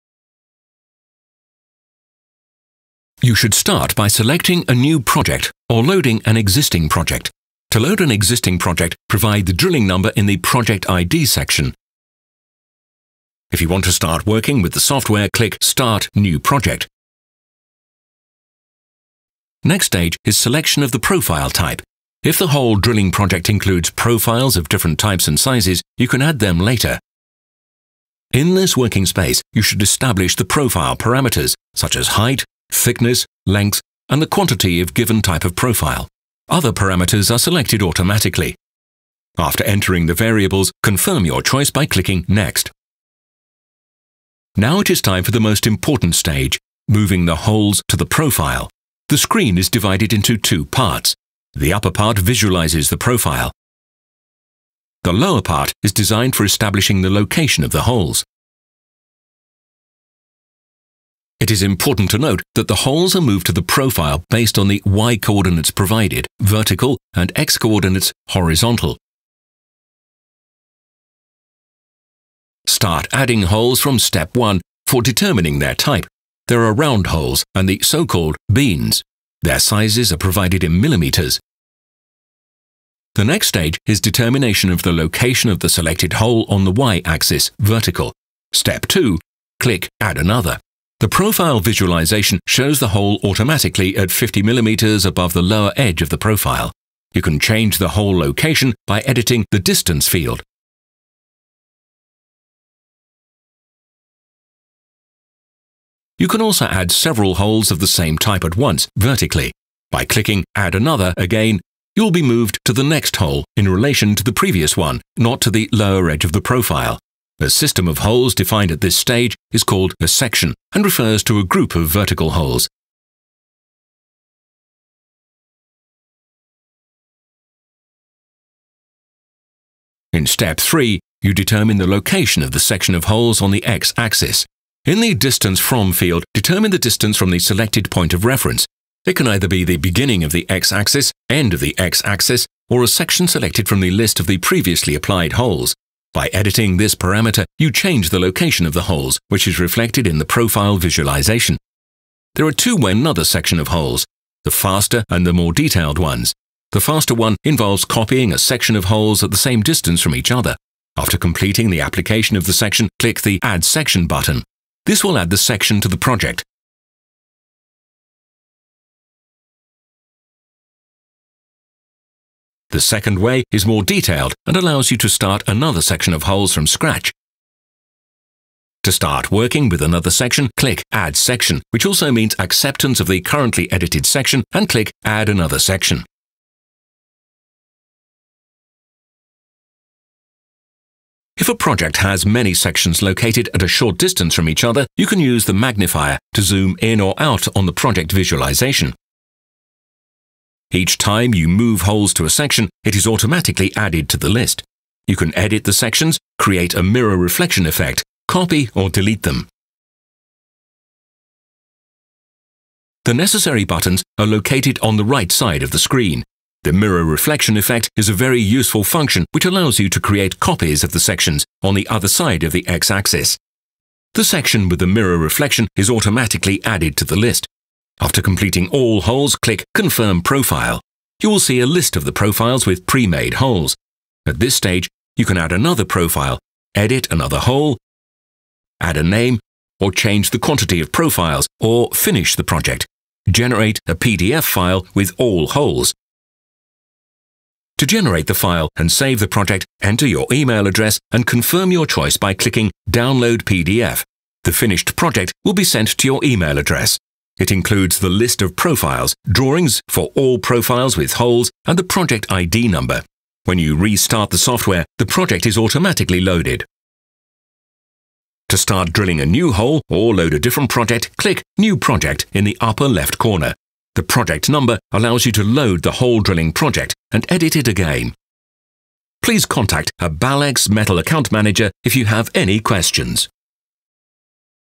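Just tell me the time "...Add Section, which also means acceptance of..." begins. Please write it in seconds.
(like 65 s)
180 s.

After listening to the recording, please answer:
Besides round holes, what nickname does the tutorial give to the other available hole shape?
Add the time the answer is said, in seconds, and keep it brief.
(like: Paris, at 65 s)
beans, at 78 s.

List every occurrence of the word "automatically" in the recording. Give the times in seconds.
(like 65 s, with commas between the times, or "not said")
37 s, 93 s, 203 s, 225 s, 265 s.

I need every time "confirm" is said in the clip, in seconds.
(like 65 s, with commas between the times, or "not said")
40 s, 229 s, 251 s.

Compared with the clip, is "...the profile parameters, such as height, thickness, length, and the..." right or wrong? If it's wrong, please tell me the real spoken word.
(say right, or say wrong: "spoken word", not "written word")
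right.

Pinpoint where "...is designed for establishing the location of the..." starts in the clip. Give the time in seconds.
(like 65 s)
55 s.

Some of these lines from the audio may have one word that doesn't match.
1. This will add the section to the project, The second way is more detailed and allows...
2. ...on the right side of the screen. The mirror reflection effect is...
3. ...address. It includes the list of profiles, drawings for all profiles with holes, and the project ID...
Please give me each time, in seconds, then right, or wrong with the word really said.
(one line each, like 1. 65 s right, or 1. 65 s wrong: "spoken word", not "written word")
1. 164 s right
2. 214 s right
3. 256 s right.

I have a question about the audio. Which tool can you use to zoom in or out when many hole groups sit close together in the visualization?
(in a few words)
magnifier.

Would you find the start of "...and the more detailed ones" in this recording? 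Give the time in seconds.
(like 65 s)
155 s.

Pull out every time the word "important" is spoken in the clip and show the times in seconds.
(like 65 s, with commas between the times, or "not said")
45 s, 61 s.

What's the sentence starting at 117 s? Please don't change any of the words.
A system of holes defined at this stage is called a section and refers to a group of vertical holes.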